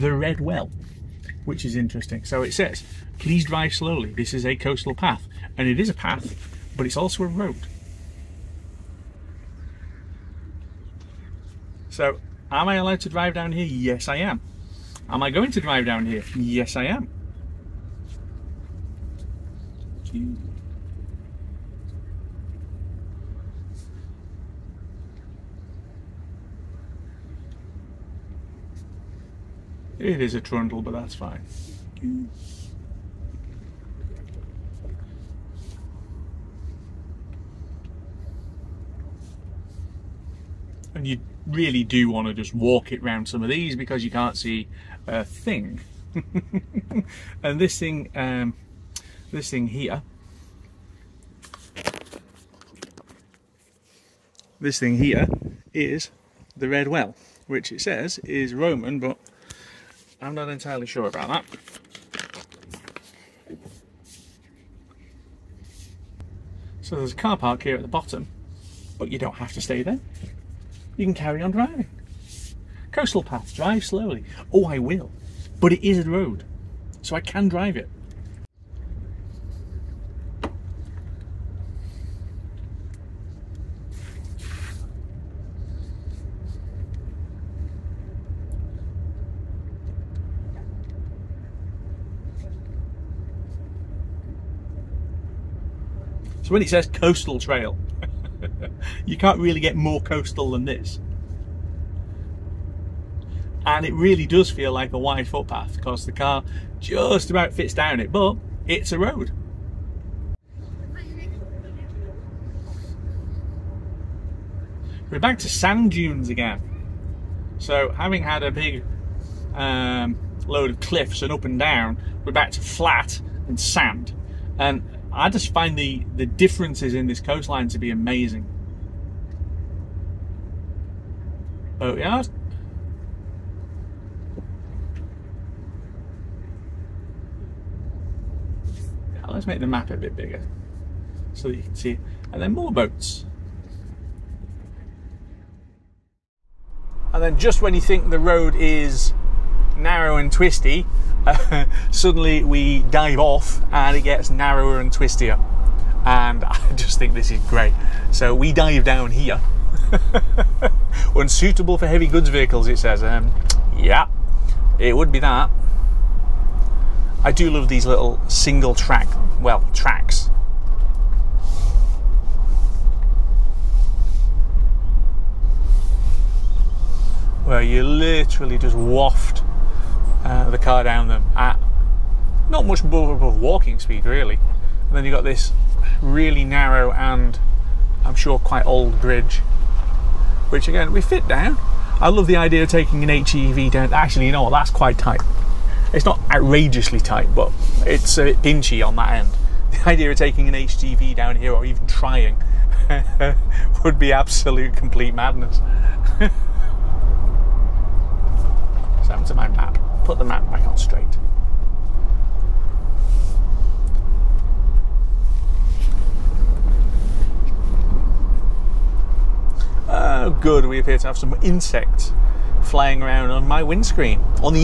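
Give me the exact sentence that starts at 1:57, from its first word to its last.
So having had a big um, load of cliffs and up and down, we're back to flat and sand.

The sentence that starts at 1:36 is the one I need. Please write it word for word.
So when it says coastal trail, you can't really get more coastal than this.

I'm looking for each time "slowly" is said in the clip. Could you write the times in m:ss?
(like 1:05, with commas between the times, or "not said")
0:03, 1:13.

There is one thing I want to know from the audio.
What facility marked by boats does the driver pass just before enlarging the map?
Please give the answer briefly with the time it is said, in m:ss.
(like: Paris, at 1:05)
Boatyard, at 2:11.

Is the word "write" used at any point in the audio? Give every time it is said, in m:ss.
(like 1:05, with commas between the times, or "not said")
not said.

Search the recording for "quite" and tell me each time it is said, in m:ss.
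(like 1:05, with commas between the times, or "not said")
3:08, 3:14.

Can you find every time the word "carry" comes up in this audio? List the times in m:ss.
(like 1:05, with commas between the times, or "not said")
1:11.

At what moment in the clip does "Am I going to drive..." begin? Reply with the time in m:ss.
0:15.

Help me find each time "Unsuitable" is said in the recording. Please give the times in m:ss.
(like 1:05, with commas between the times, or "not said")
2:41.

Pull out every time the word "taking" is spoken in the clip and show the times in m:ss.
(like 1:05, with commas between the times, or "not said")
3:12, 3:20.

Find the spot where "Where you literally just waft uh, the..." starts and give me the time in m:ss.
2:57.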